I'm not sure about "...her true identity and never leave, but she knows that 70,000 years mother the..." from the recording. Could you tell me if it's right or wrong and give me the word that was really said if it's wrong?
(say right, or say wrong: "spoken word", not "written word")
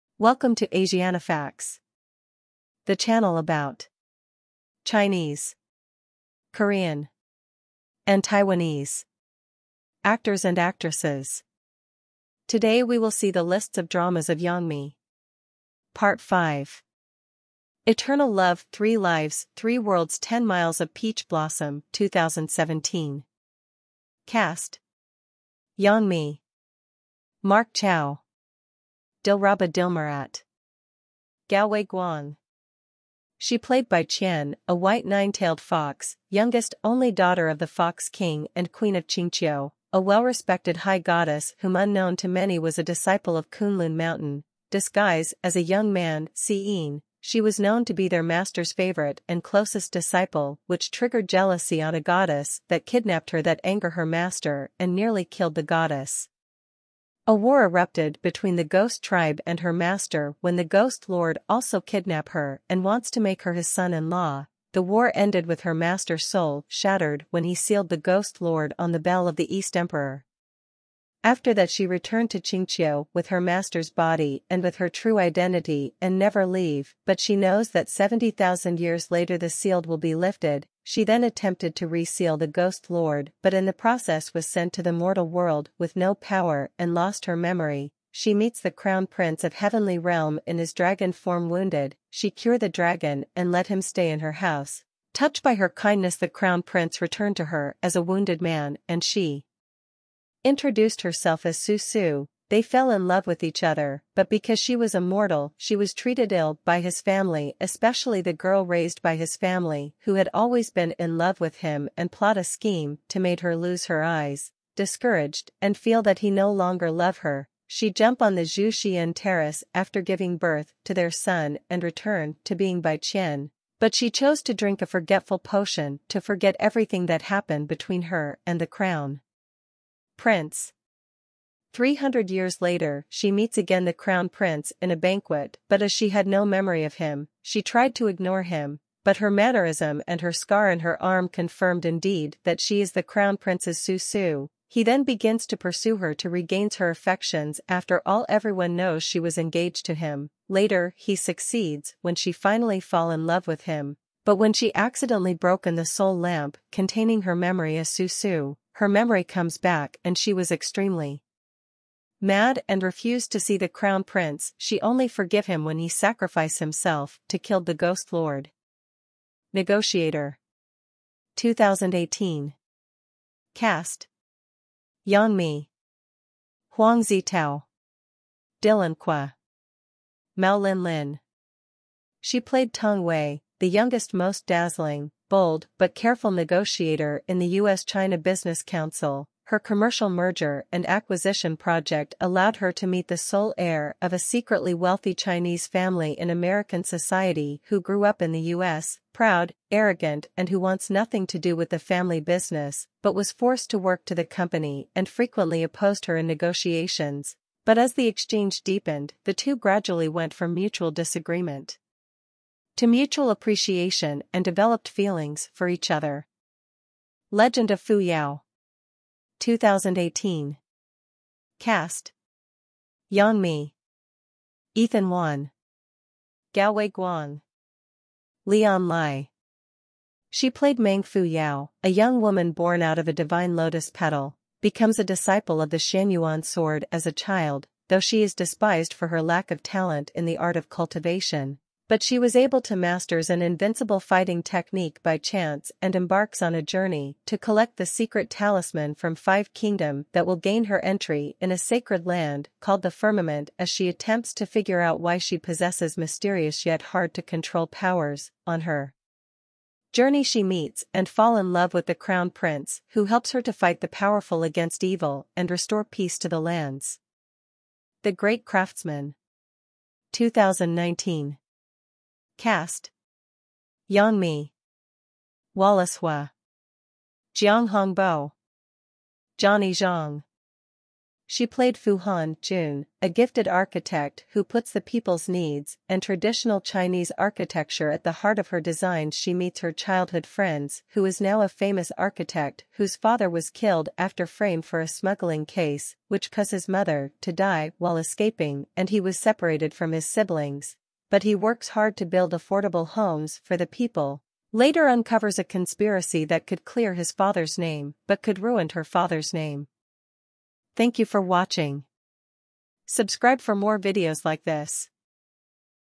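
wrong: "later", not "mother".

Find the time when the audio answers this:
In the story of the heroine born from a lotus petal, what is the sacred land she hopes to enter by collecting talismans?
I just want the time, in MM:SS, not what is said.
04:12.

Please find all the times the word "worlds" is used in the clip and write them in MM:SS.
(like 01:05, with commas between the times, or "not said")
00:19, 01:25.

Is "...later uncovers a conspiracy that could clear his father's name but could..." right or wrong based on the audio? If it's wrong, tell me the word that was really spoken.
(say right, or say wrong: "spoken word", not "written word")
right.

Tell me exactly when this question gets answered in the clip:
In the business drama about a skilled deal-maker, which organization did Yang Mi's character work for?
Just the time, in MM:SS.
03:07.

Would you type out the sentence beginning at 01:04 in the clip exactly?
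The war ended with her master's soul shattered when he sealed the ghost lord on the bell of the East Emperor.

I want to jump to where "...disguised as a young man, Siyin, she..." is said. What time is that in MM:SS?
00:44.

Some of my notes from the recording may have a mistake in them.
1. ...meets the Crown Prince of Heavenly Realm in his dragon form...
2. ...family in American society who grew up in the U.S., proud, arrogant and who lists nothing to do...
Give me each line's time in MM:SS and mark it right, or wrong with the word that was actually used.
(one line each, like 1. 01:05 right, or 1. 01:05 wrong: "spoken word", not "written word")
1. 01:28 right
2. 03:15 wrong: "wants", not "lists".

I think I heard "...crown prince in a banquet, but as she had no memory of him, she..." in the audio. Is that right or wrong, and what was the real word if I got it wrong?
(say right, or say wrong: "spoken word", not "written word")
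right.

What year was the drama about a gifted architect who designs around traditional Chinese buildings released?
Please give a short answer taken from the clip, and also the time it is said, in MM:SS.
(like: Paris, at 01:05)
2019, at 04:30.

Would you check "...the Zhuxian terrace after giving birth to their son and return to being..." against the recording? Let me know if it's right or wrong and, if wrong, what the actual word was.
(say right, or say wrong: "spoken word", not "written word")
right.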